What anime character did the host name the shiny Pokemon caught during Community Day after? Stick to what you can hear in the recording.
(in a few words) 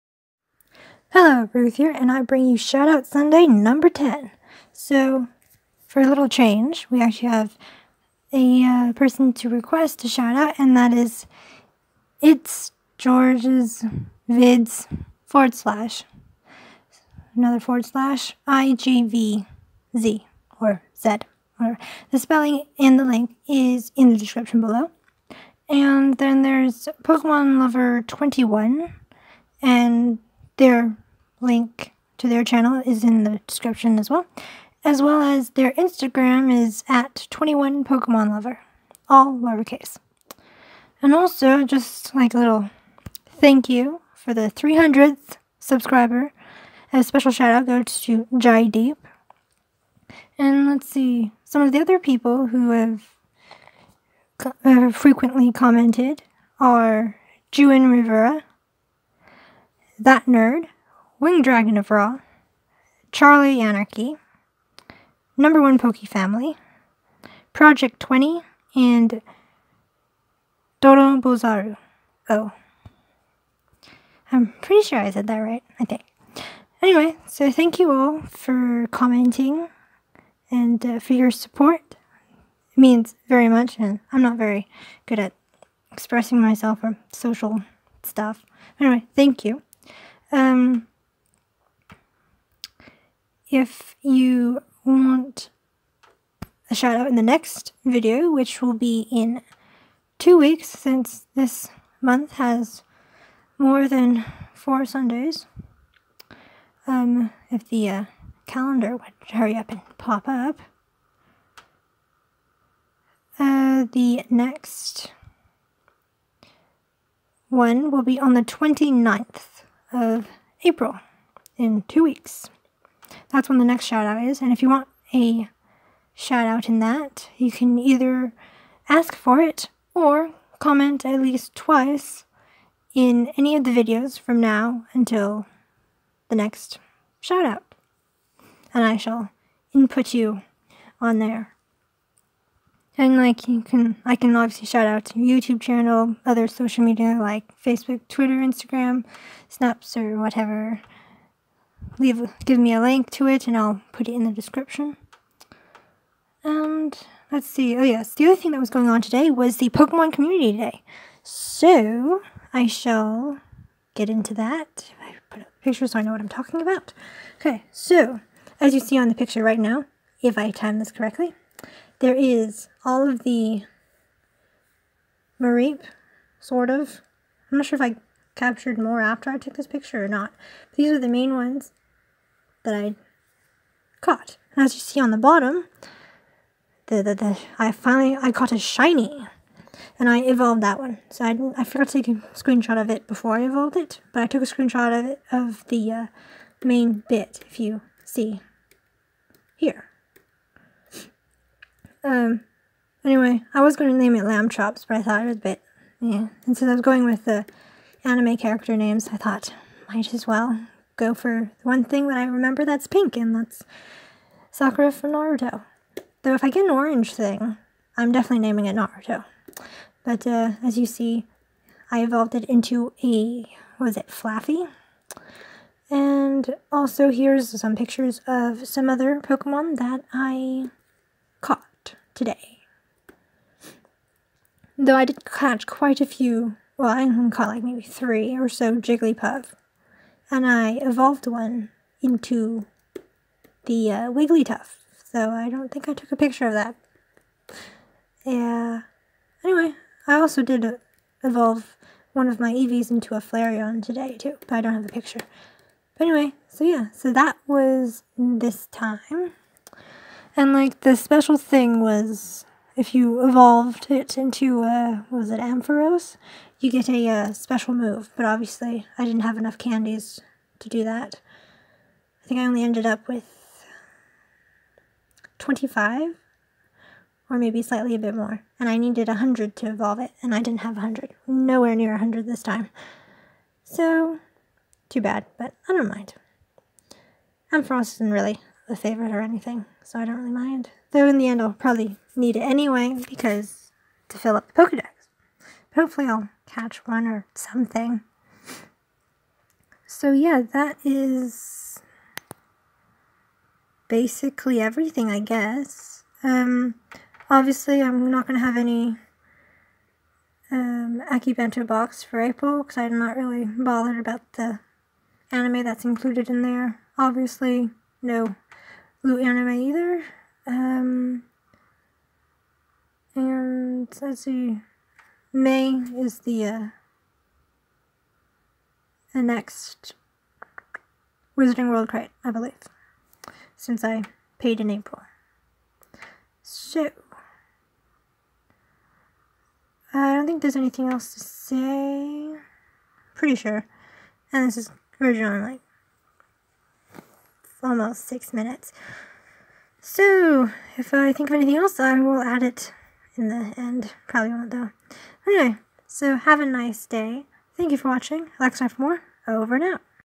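Sakura.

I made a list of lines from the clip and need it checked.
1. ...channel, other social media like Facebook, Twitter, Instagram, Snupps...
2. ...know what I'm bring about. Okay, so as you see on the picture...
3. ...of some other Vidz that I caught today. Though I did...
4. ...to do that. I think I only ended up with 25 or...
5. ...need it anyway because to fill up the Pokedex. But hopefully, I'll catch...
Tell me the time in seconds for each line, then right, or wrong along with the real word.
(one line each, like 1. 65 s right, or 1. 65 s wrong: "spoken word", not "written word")
1. 145 s right
2. 166 s wrong: "talking", not "bring"
3. 228 s wrong: "Pokemon", not "Vidz"
4. 270 s right
5. 292 s right.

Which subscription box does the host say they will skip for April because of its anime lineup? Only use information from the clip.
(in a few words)
Akibento box.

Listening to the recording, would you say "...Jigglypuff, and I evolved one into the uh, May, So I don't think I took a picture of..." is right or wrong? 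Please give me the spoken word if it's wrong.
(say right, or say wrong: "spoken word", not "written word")
wrong: "Wigglytuff", not "May".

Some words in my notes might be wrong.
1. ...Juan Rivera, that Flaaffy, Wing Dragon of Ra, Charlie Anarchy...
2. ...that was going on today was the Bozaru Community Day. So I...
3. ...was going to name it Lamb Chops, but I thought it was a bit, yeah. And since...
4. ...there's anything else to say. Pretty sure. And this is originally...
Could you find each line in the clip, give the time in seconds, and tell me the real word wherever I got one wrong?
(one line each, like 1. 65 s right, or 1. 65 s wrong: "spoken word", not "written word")
1. 57 s wrong: "Nerd", not "Flaaffy"
2. 158 s wrong: "Pokemon", not "Bozaru"
3. 203 s right
4. 340 s right.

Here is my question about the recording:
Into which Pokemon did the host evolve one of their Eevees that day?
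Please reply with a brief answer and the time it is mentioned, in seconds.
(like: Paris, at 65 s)
Flareon, at 253 s.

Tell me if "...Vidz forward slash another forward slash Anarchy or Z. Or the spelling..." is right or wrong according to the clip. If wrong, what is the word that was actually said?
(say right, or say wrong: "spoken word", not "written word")
wrong: "IGVZ", not "Anarchy".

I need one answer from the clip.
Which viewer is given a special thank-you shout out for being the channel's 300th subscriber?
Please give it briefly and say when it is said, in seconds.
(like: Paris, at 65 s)
Jai Deep, at 48 s.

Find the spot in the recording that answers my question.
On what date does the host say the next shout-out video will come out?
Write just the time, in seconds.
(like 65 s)
118 s.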